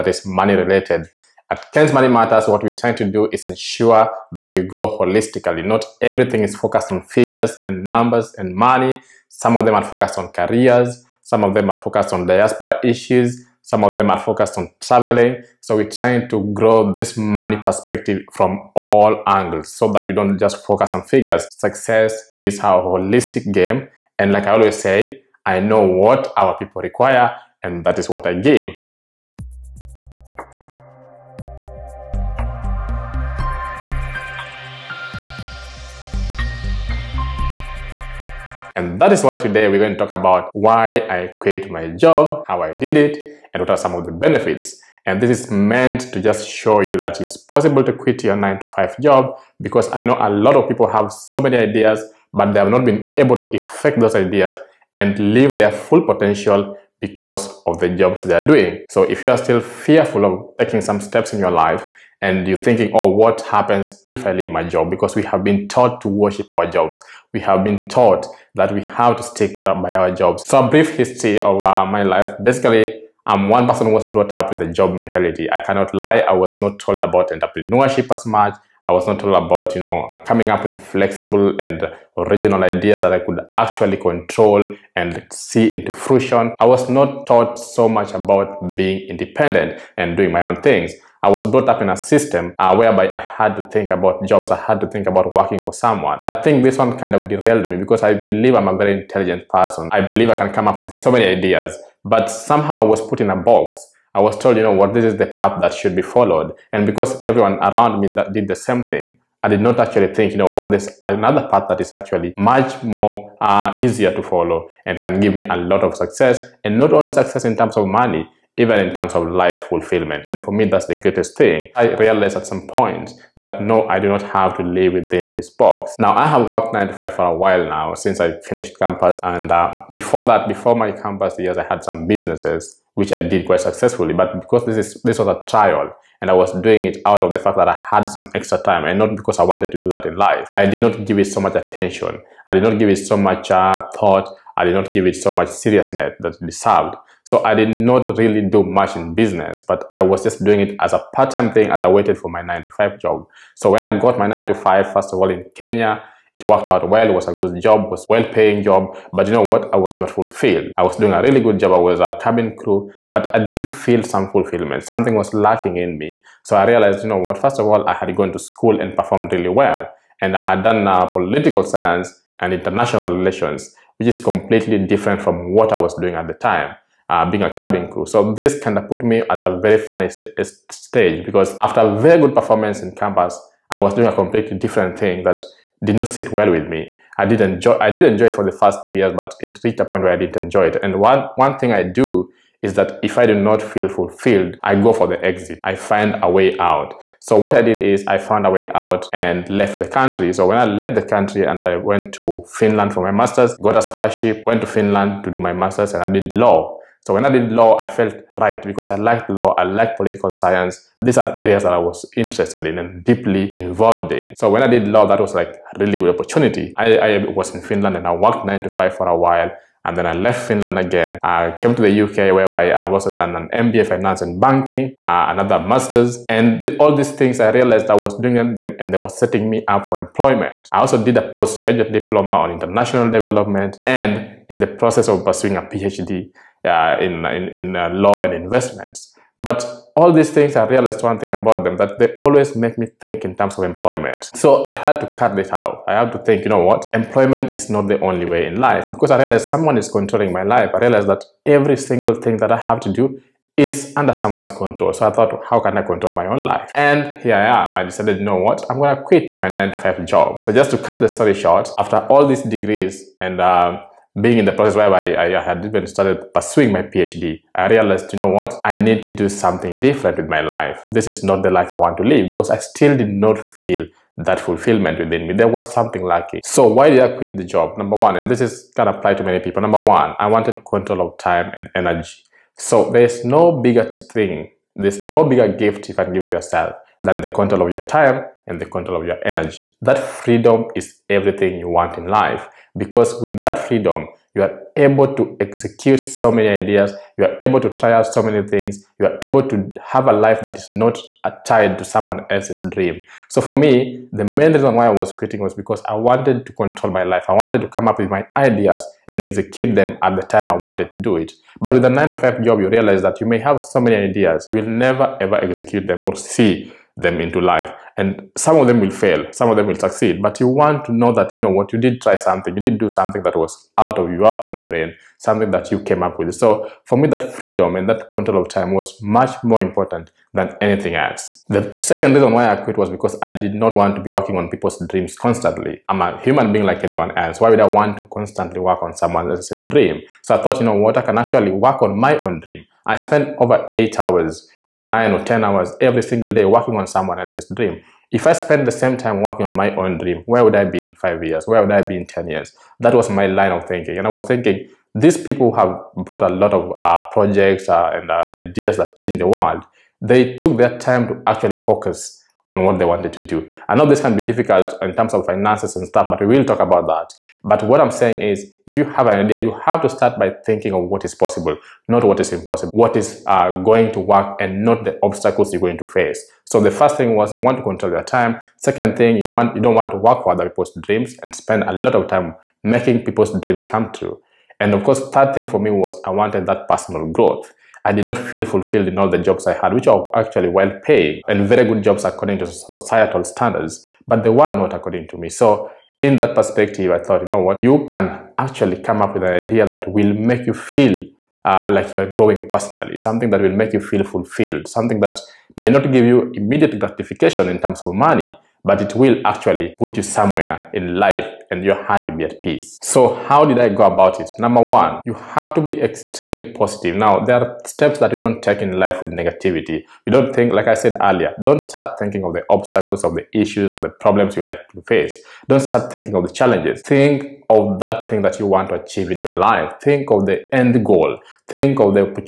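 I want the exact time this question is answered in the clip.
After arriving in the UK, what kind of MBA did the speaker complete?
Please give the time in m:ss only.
3:43.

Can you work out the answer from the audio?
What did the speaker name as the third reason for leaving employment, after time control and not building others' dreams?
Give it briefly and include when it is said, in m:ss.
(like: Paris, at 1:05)
Personal growth, at 6:26.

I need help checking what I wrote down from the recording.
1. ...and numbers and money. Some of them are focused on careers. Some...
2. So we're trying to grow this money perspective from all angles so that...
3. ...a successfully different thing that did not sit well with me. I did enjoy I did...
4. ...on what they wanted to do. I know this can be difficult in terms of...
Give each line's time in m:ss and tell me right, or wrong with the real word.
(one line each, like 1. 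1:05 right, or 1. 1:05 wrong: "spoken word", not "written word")
1. 0:07 right
2. 0:15 right
3. 3:04 wrong: "completely", not "successfully"
4. 6:02 right.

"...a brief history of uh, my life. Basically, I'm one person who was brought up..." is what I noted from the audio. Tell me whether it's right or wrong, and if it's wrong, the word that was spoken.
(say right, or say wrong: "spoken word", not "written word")
right.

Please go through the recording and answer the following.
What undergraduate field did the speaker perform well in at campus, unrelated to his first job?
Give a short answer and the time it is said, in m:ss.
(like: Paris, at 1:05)
Political science and international relations, at 2:51.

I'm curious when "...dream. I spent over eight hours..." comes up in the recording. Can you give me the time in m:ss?
5:42.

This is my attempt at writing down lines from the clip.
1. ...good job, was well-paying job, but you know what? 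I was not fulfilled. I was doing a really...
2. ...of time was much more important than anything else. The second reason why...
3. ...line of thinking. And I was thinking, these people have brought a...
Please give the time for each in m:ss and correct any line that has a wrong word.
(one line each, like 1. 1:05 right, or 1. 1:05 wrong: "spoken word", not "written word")
1. 2:37 right
2. 5:28 right
3. 5:53 right.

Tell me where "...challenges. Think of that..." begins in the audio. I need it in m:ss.
7:06.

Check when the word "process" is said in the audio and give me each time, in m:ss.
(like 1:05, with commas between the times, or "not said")
3:54, 4:24.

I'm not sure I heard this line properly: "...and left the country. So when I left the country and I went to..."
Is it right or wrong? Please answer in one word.
right.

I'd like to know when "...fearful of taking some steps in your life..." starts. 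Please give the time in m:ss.
0:59.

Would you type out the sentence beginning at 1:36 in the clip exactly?
And I think this one kind of derailed me because I believe I'm a very intelligent person.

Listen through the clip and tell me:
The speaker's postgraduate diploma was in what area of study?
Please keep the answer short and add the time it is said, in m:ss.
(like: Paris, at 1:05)
International development, at 3:52.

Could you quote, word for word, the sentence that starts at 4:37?
Number one, and this is gonna apply to many people.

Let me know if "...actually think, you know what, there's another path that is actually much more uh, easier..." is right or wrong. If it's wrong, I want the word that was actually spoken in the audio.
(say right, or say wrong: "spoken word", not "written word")
right.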